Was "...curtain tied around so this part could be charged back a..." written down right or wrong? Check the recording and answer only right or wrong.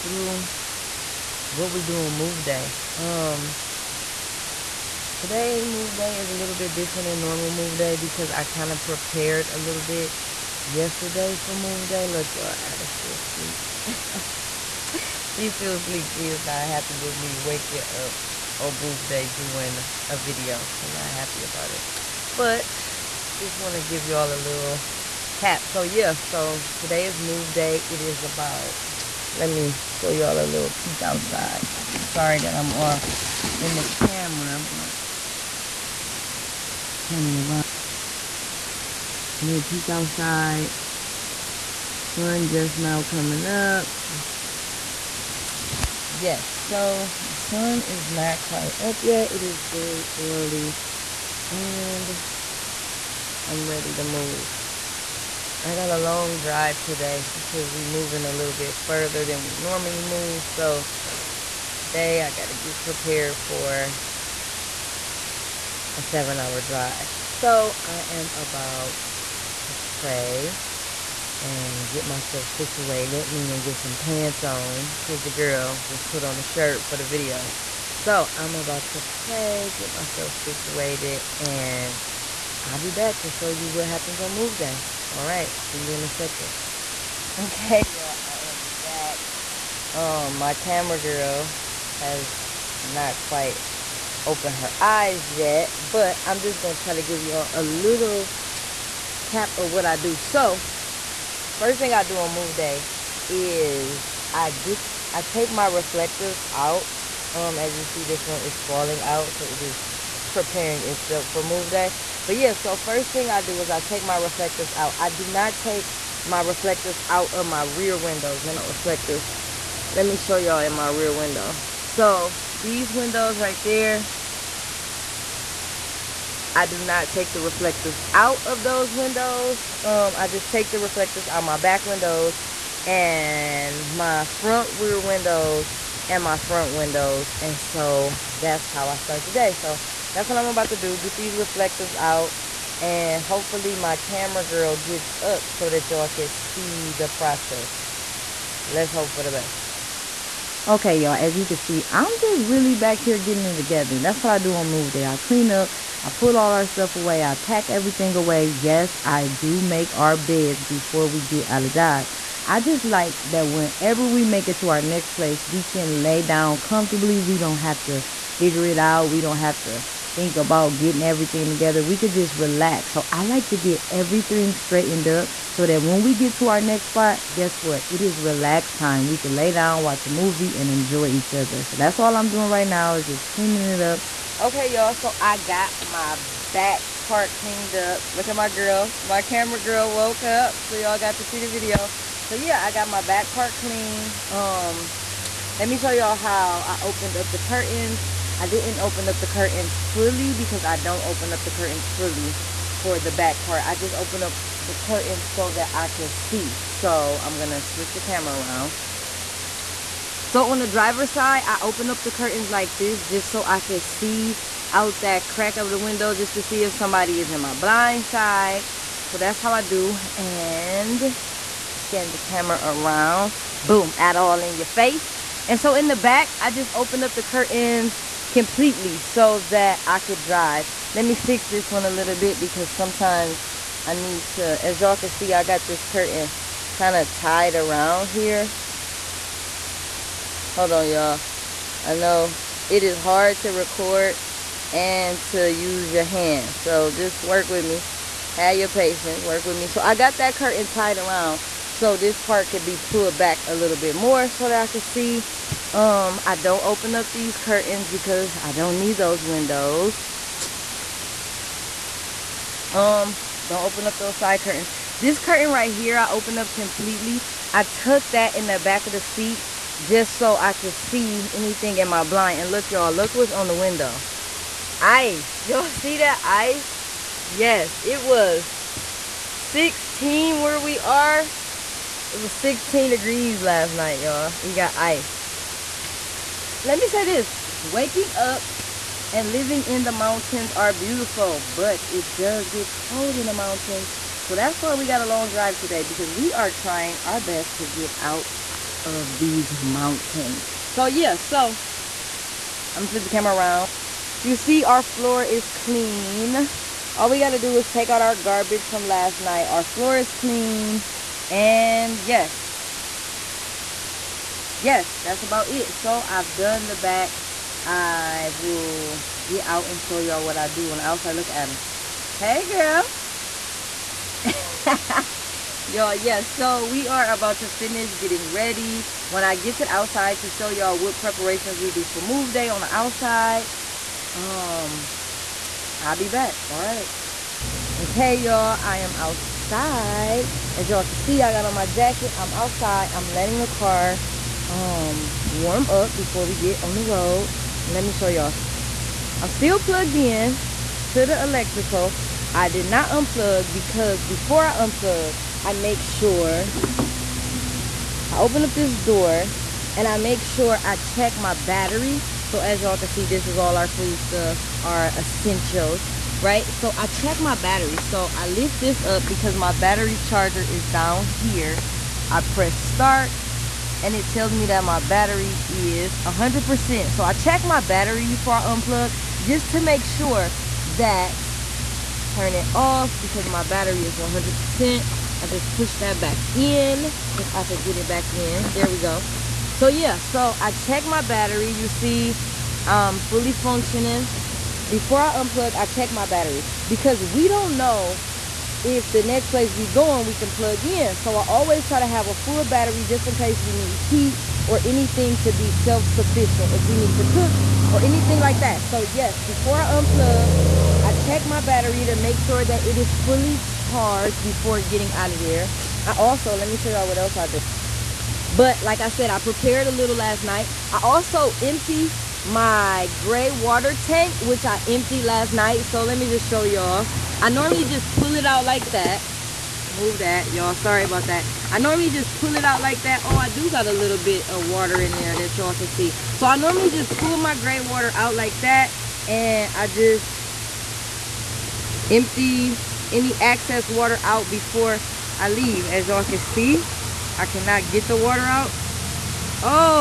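wrong.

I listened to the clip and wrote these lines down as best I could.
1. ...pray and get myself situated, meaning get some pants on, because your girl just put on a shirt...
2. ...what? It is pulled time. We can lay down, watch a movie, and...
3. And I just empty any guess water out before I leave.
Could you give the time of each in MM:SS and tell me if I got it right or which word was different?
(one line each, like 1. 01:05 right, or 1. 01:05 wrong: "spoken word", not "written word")
1. 01:09 right
2. 02:57 wrong: "relaxed", not "pulled"
3. 07:19 wrong: "excess", not "guess".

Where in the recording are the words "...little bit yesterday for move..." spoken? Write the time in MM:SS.
00:09.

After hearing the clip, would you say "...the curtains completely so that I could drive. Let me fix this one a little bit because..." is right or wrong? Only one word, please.
right.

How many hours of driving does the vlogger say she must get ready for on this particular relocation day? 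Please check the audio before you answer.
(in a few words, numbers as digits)
7.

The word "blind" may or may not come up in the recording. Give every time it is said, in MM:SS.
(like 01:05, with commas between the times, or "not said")
03:37, 04:32.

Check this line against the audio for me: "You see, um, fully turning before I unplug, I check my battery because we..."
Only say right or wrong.
wrong.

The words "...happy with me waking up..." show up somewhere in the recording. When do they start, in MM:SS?
00:16.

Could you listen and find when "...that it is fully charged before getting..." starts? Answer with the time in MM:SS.
06:52.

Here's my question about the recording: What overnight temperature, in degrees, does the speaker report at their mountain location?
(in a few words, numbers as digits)
16.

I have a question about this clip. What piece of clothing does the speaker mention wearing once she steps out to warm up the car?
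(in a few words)
jacket.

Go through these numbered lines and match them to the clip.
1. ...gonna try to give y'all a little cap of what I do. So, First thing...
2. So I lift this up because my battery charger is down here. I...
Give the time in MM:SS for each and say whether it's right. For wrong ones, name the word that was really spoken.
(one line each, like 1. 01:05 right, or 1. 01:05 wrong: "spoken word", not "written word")
1. 01:36 right
2. 06:07 right.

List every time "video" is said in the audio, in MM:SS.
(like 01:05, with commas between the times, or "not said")
00:20, 01:17, 03:11.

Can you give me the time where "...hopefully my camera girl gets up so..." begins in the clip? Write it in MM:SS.
02:23.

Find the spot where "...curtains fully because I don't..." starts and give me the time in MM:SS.
03:19.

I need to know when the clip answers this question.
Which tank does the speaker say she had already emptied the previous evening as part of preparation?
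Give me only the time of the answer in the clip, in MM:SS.
07:02.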